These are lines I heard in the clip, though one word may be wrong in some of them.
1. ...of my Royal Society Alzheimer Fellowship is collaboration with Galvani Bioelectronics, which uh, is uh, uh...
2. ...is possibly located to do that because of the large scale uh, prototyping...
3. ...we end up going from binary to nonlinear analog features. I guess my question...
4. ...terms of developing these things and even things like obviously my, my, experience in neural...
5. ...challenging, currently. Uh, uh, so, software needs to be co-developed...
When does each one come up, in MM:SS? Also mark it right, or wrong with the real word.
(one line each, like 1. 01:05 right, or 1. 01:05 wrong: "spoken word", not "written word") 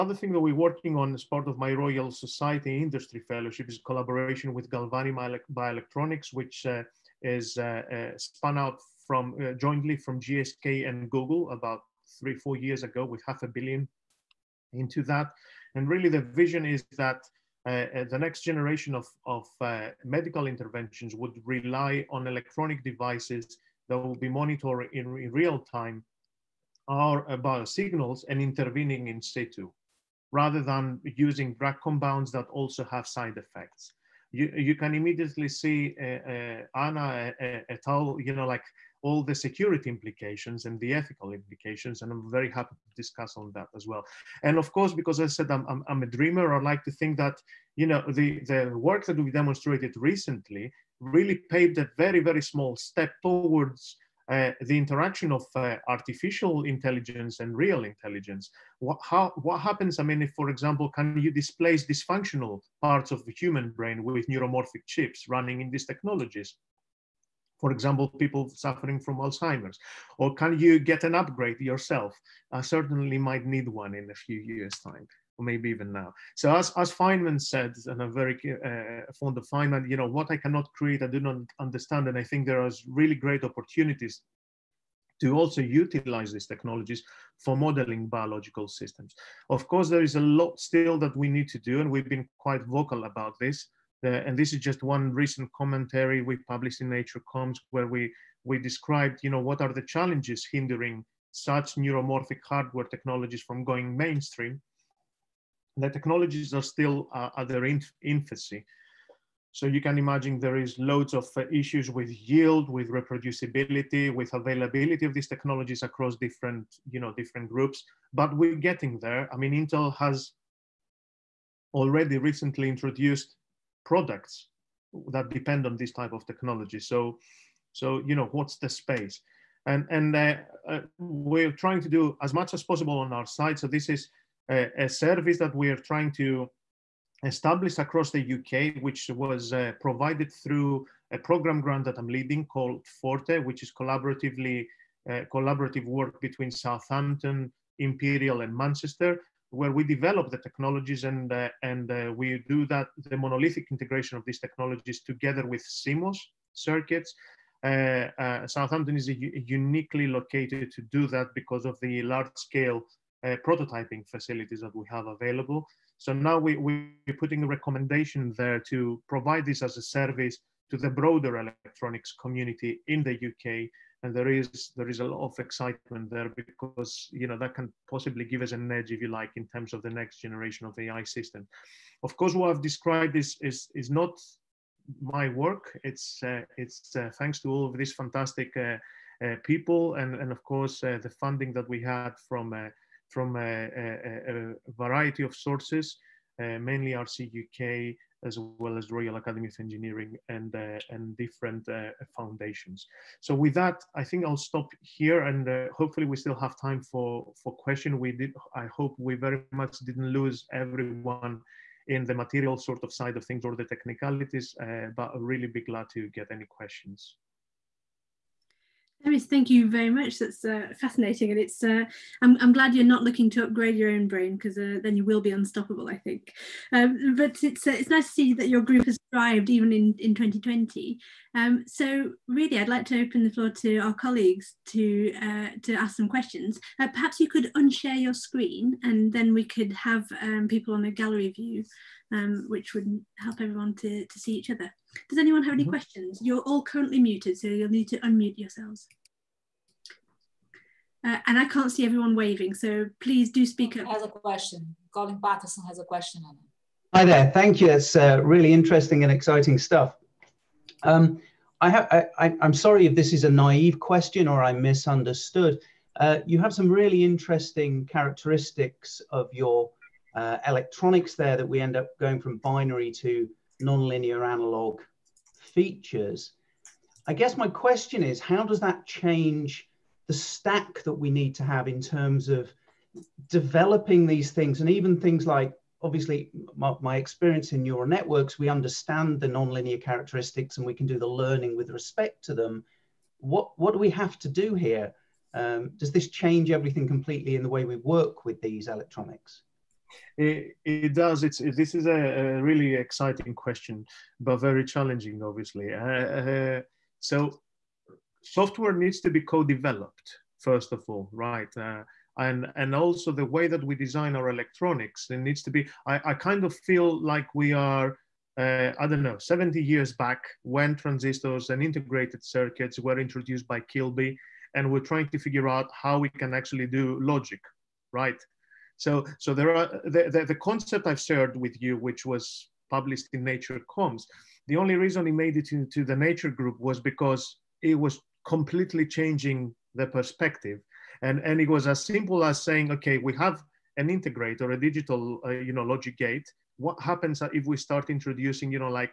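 1. 00:01 wrong: "Industry", not "Alzheimer"
2. 02:38 wrong: "uniquely", not "possibly"
3. 04:31 right
4. 04:41 right
5. 05:04 wrong: "obviously", not "currently".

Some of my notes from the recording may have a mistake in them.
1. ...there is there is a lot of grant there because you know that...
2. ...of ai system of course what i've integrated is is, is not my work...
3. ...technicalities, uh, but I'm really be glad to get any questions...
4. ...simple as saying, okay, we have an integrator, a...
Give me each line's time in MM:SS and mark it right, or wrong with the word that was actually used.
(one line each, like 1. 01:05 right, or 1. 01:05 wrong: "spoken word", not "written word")
1. 02:54 wrong: "excitement", not "grant"
2. 03:00 wrong: "described", not "integrated"
3. 03:33 right
4. 05:41 right.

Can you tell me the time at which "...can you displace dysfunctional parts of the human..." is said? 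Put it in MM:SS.
01:00.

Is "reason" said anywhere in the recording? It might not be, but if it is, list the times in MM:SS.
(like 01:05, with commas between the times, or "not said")
05:34.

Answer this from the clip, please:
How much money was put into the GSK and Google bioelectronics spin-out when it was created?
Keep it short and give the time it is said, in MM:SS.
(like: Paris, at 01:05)
half a billion, at 00:13.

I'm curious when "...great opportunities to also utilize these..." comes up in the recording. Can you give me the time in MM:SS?
01:23.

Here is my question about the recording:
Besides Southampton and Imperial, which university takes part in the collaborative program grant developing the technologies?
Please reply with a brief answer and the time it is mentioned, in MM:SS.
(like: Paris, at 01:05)
Manchester, at 02:28.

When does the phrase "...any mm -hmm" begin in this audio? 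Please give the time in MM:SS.
04:05.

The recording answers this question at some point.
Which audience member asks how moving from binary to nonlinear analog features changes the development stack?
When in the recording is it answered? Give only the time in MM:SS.
04:14.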